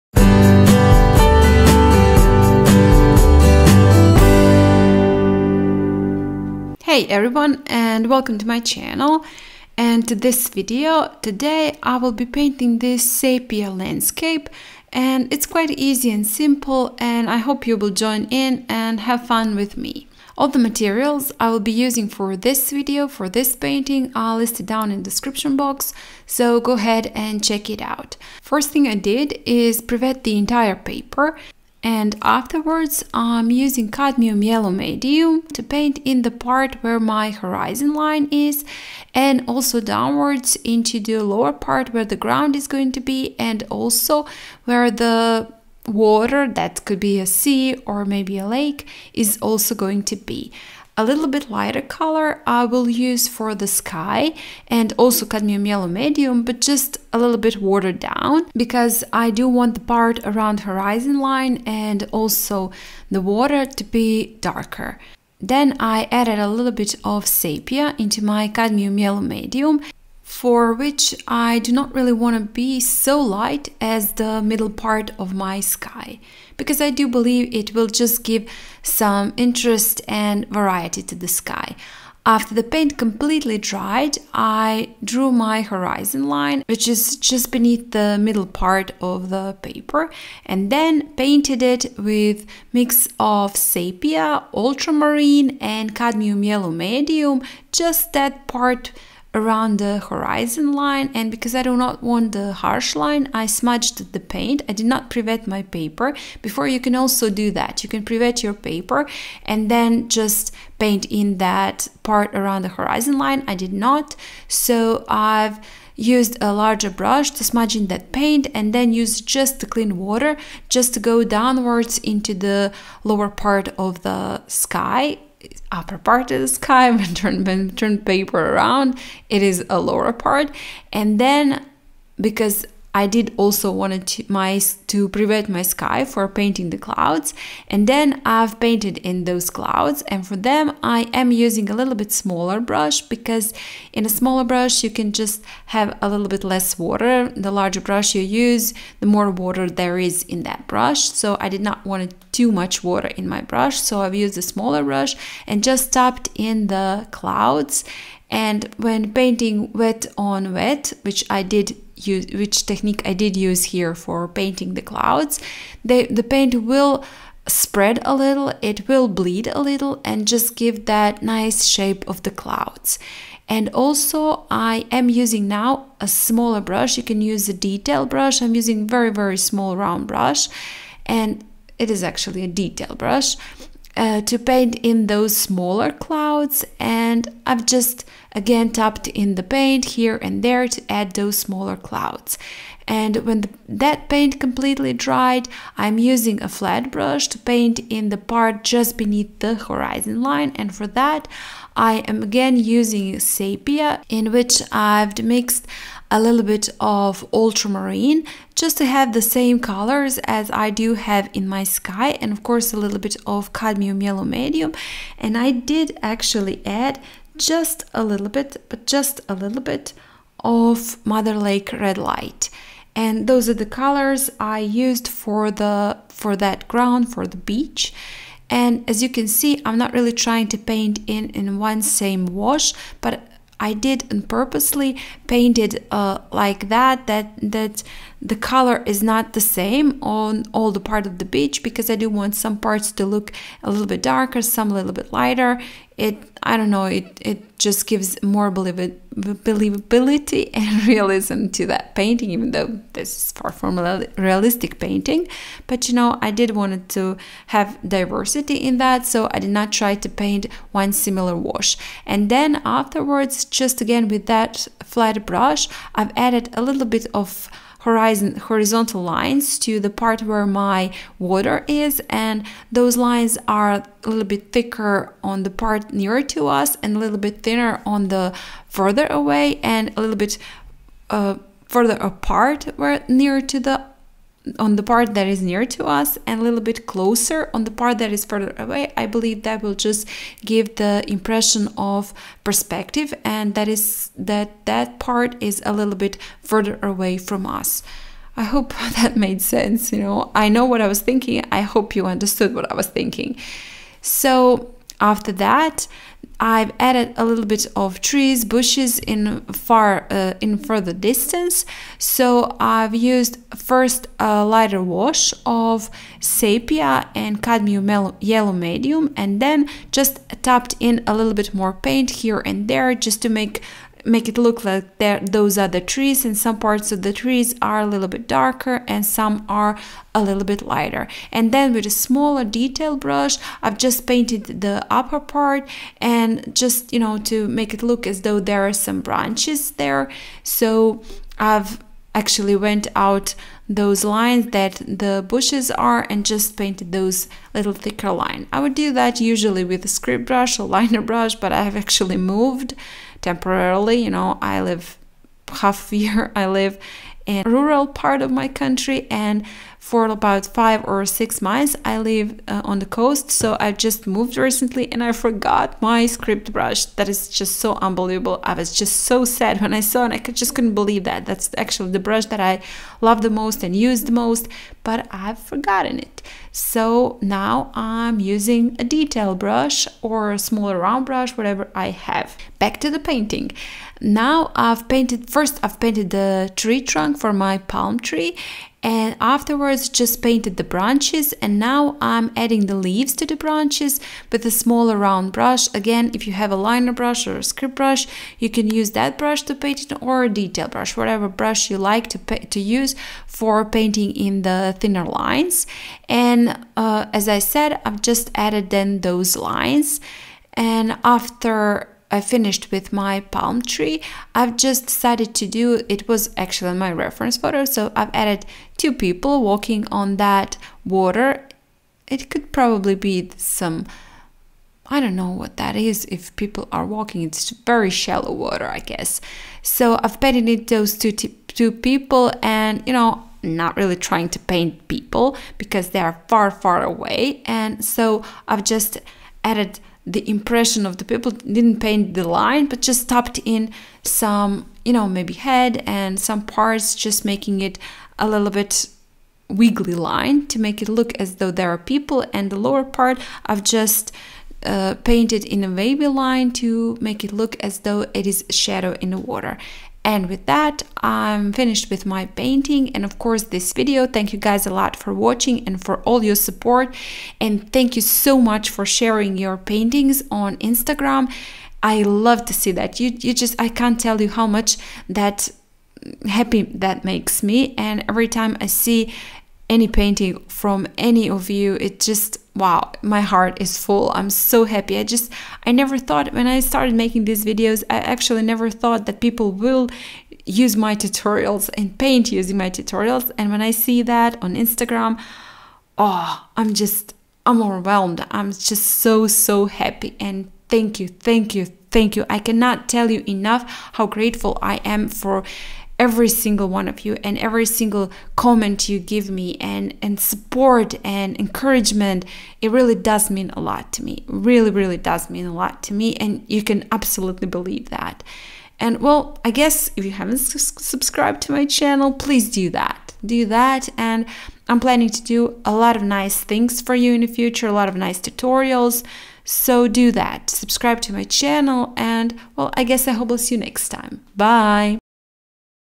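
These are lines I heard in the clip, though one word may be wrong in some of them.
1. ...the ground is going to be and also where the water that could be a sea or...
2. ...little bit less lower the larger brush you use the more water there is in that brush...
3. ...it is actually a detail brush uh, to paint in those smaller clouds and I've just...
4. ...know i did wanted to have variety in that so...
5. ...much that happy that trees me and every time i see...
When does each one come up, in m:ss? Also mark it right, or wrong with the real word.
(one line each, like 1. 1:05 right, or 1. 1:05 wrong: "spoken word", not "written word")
1. 0:42 right
2. 2:26 wrong: "water", not "lower"
3. 3:01 right
4. 4:15 wrong: "diversity", not "variety"
5. 7:54 wrong: "makes", not "trees".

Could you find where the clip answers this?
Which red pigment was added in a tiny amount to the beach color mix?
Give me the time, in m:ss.
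3:41.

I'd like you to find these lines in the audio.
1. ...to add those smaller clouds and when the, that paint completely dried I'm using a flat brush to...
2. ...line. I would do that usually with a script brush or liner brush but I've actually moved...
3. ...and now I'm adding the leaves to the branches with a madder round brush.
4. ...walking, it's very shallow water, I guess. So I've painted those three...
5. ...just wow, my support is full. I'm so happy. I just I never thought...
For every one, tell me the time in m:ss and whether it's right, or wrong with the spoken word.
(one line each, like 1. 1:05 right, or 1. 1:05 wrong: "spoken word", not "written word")
1. 3:10 right
2. 5:48 right
3. 6:31 wrong: "smaller", not "madder"
4. 7:06 wrong: "two", not "three"
5. 8:02 wrong: "heart", not "support".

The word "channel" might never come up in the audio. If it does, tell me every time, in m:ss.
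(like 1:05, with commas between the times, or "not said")
0:08, 8:41, 8:51.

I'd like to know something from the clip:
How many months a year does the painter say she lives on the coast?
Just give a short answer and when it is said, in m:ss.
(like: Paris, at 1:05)
5 or 6, at 6:00.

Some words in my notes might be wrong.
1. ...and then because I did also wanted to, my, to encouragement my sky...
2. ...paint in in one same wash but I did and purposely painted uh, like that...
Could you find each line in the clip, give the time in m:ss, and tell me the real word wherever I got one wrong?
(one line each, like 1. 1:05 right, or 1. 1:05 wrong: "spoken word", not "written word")
1. 2:10 wrong: "prevent", not "encouragement"
2. 3:50 right.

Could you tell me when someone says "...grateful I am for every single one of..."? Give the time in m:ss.
8:24.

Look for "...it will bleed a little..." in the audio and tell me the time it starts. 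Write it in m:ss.
2:48.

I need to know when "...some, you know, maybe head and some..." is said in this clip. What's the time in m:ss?
7:24.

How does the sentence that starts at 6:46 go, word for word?
And uh, as I said, I've just added then those lines.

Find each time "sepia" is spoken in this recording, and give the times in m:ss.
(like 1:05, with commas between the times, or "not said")
0:13, 1:07, 1:33, 3:23, 5:16.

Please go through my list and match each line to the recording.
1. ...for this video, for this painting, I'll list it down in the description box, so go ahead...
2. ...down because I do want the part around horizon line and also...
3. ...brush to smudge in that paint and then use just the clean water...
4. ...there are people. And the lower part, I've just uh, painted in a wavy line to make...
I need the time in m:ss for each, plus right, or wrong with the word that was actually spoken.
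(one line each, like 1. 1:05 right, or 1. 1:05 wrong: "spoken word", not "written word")
1. 0:22 right
2. 0:57 right
3. 1:56 right
4. 7:31 right.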